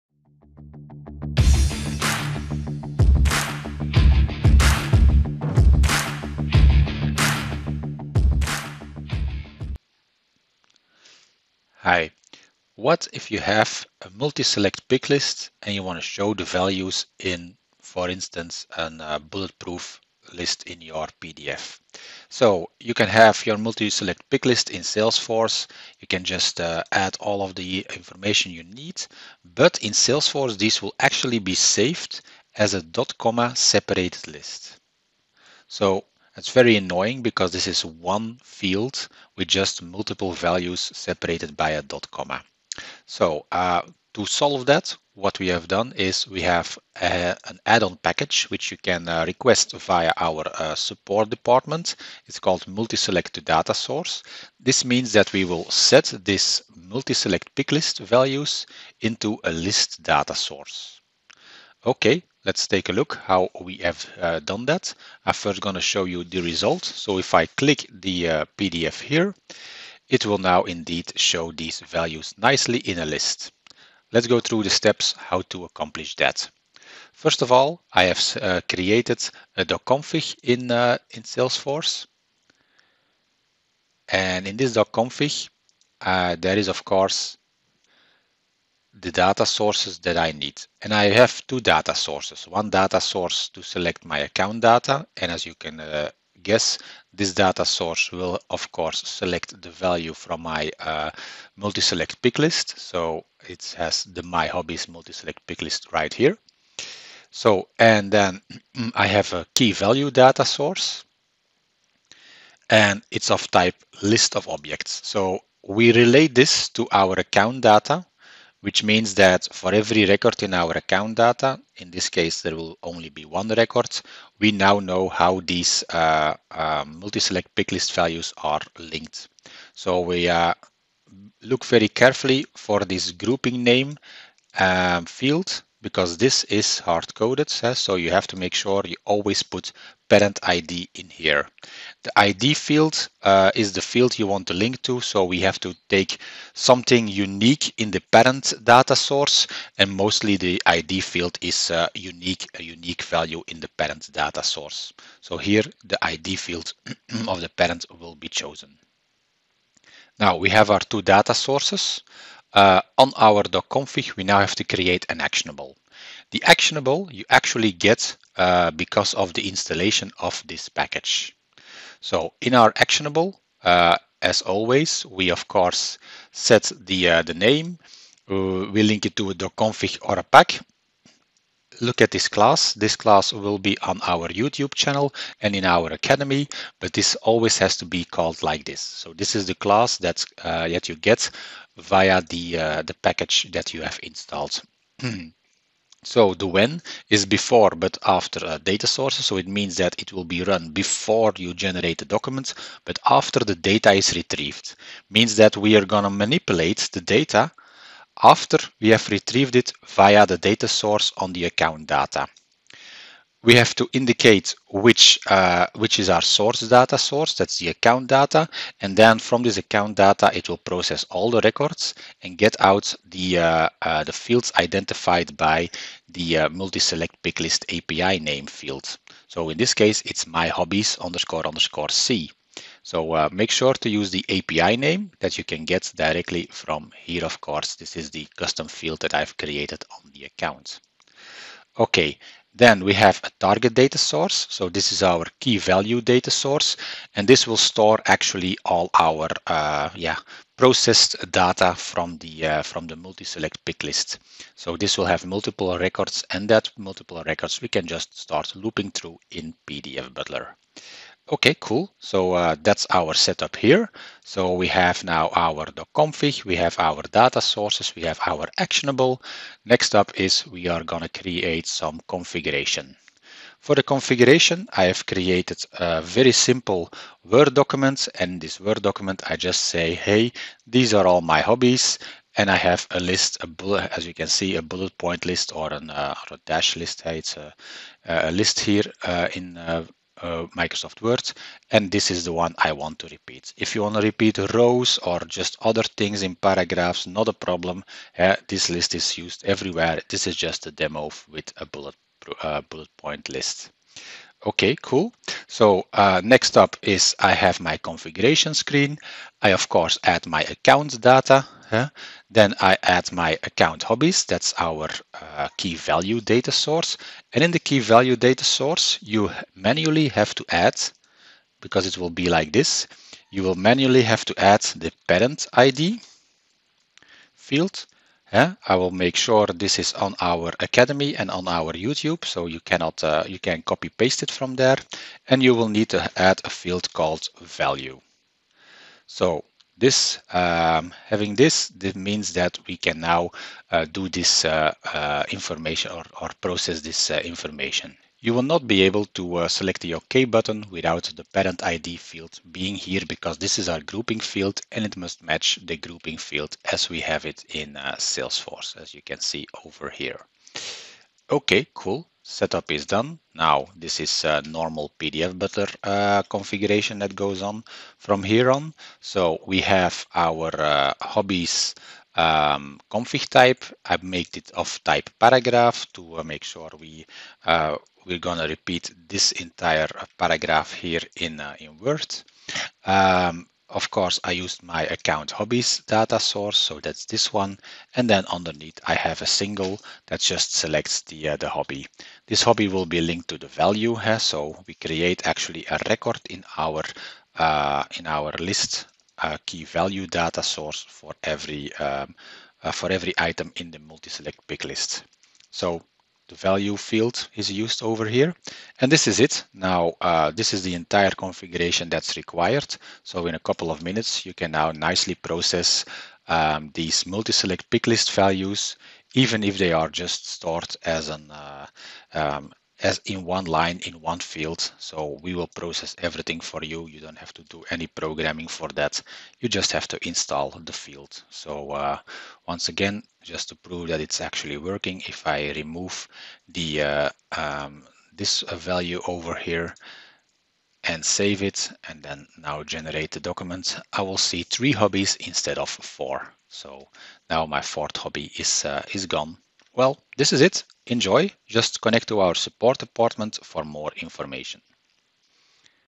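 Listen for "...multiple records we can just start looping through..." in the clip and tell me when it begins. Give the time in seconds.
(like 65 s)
256 s.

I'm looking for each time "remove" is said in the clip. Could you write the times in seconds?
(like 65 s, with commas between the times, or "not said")
435 s.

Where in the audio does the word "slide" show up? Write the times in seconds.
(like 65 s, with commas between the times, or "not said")
not said.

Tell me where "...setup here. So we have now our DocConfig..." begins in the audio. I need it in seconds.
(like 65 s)
263 s.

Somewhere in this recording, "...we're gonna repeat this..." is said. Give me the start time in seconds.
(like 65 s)
378 s.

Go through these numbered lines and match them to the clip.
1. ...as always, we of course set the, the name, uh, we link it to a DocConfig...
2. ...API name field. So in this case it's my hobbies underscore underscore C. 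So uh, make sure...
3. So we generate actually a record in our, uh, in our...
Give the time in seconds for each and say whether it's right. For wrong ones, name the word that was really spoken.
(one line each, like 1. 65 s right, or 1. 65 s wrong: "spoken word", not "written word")
1. 174 s right
2. 227 s right
3. 394 s wrong: "create", not "generate".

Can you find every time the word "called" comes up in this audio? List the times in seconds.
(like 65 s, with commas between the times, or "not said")
52 s, 188 s, 336 s.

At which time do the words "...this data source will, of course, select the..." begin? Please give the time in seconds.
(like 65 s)
97 s.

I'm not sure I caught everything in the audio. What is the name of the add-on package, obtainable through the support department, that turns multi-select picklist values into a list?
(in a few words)
multi-select data source.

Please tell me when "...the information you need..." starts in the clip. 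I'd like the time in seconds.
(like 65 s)
27 s.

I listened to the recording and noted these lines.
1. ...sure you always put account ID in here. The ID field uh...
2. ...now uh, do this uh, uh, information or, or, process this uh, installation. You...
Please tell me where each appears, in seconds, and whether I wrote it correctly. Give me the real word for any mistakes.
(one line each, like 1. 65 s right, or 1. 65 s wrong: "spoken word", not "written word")
1. 138 s wrong: "parent", not "account"
2. 342 s wrong: "information", not "installation".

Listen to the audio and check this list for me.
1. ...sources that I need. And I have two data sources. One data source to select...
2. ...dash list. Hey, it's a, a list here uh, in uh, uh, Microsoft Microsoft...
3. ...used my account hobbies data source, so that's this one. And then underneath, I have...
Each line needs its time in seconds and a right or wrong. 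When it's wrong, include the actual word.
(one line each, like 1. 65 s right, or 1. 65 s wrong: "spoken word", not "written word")
1. 89 s right
2. 286 s wrong: "Word", not "Microsoft"
3. 384 s right.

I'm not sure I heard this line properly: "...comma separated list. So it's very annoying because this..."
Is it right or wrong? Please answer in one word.
right.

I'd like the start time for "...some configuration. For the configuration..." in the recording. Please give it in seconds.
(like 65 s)
271 s.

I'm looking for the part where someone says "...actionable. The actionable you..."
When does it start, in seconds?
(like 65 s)
165 s.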